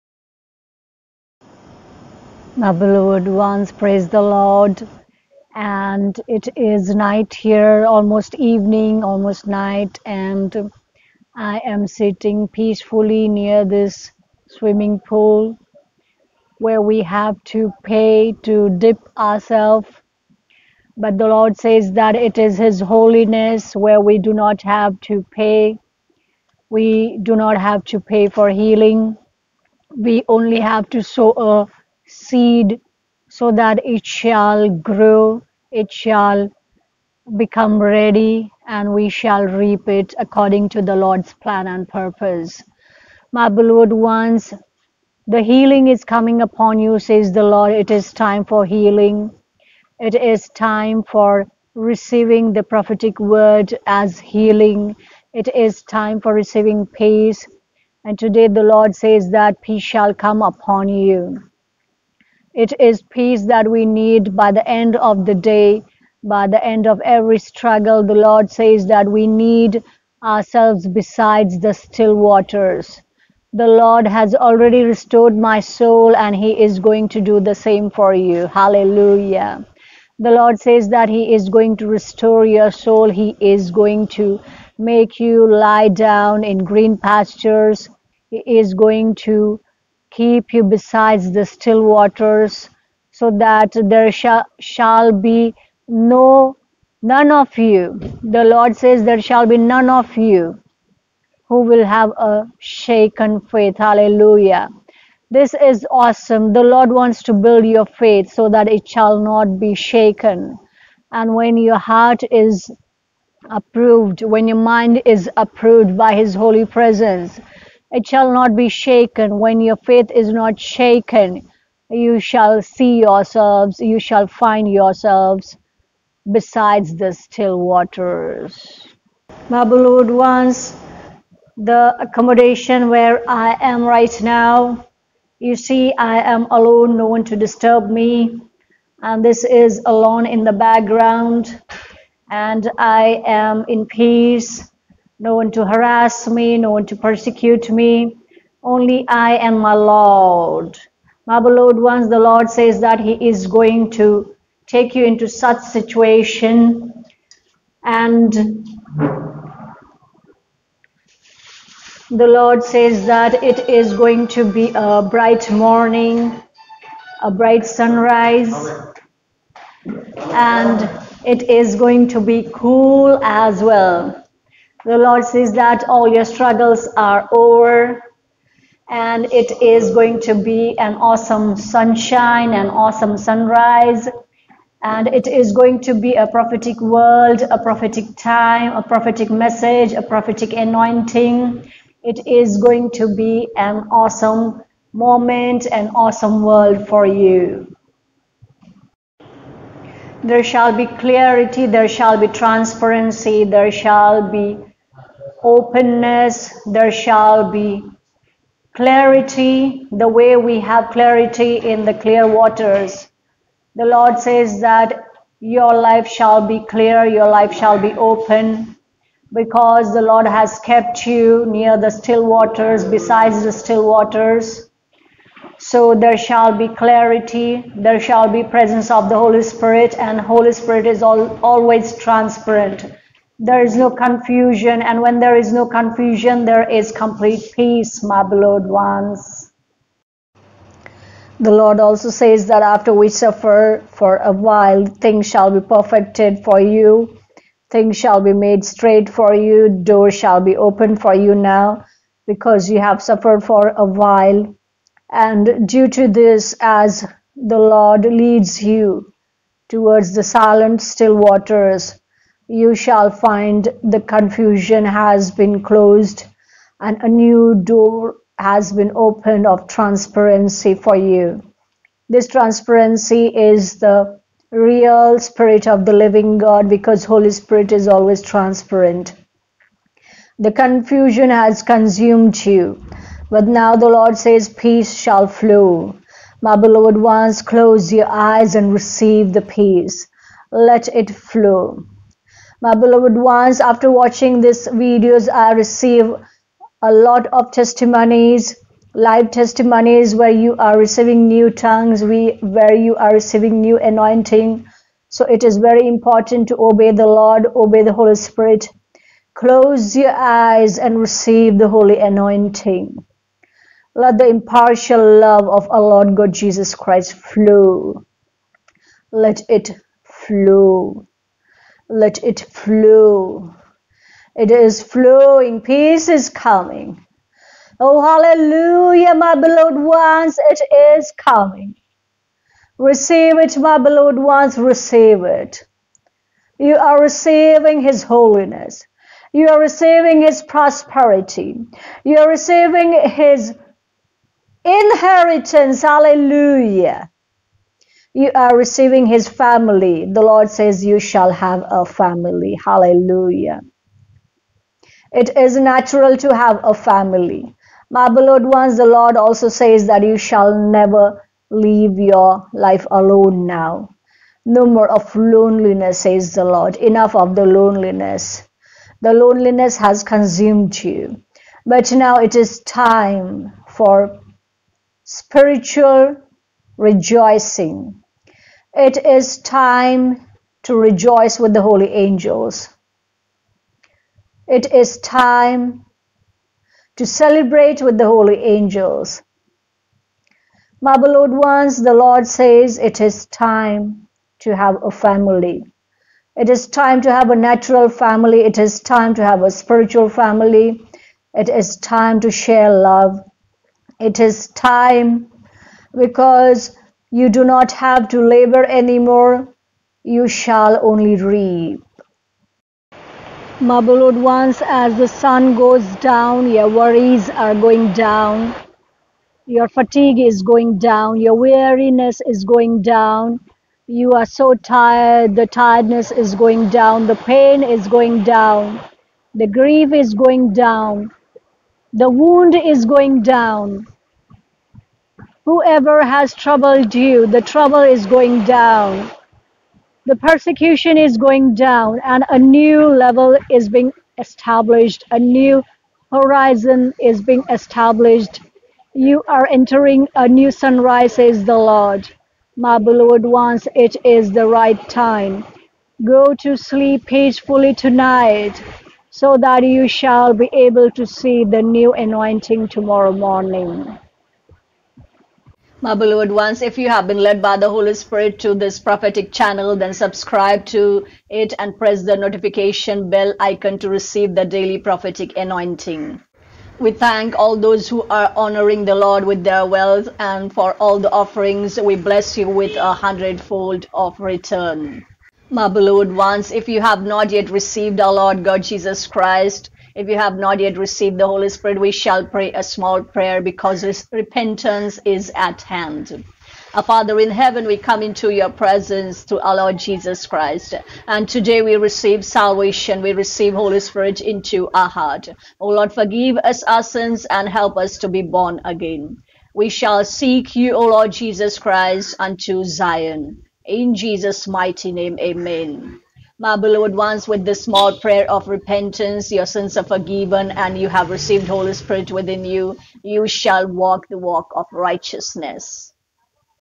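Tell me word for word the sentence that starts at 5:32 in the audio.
Receive it, my beloved ones, receive it.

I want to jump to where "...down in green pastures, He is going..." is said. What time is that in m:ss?
1:25.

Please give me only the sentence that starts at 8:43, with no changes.
You shall walk the walk of righteousness.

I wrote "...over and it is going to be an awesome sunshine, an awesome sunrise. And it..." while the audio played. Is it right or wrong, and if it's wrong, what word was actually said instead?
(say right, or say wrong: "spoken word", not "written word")
right.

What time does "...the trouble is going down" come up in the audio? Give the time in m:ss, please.
7:17.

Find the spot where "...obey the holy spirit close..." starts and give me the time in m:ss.
5:07.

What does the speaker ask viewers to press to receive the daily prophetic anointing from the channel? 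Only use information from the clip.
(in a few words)
The notification bell icon.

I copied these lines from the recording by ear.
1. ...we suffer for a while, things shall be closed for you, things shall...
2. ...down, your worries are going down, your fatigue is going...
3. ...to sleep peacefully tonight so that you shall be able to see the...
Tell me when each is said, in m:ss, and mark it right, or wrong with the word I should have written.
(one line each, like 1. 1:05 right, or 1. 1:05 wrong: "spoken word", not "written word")
1. 4:02 wrong: "perfected", not "closed"
2. 6:55 right
3. 7:36 right.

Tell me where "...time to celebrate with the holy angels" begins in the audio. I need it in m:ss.
6:24.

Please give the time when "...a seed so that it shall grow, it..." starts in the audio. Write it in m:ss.
0:31.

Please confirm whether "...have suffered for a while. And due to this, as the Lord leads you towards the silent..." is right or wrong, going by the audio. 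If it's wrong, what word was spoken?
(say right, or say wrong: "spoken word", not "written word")
right.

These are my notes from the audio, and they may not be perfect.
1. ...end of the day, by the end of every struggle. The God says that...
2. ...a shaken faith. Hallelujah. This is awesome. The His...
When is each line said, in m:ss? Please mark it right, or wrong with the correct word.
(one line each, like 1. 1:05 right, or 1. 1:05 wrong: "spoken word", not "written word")
1. 1:04 wrong: "Lord", not "God"
2. 1:42 wrong: "Lord", not "His".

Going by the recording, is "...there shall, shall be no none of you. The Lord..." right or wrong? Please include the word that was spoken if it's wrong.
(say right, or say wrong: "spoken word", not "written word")
right.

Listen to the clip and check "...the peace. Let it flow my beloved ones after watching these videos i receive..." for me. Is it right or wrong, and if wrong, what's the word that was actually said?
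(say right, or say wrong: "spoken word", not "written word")
right.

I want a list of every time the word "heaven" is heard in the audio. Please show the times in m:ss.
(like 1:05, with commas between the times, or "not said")
8:17.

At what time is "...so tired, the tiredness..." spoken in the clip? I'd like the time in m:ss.
7:04.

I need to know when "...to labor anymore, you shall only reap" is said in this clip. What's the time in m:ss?
6:48.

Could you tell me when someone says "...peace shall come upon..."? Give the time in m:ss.
0:59.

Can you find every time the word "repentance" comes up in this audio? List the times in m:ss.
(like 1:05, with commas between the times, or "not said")
8:14, 8:38.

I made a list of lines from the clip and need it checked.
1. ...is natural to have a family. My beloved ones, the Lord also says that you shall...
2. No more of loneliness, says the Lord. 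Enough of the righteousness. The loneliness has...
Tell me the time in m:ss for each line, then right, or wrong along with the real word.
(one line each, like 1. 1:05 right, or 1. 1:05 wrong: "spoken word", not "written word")
1. 5:55 right
2. 6:04 wrong: "loneliness", not "righteousness".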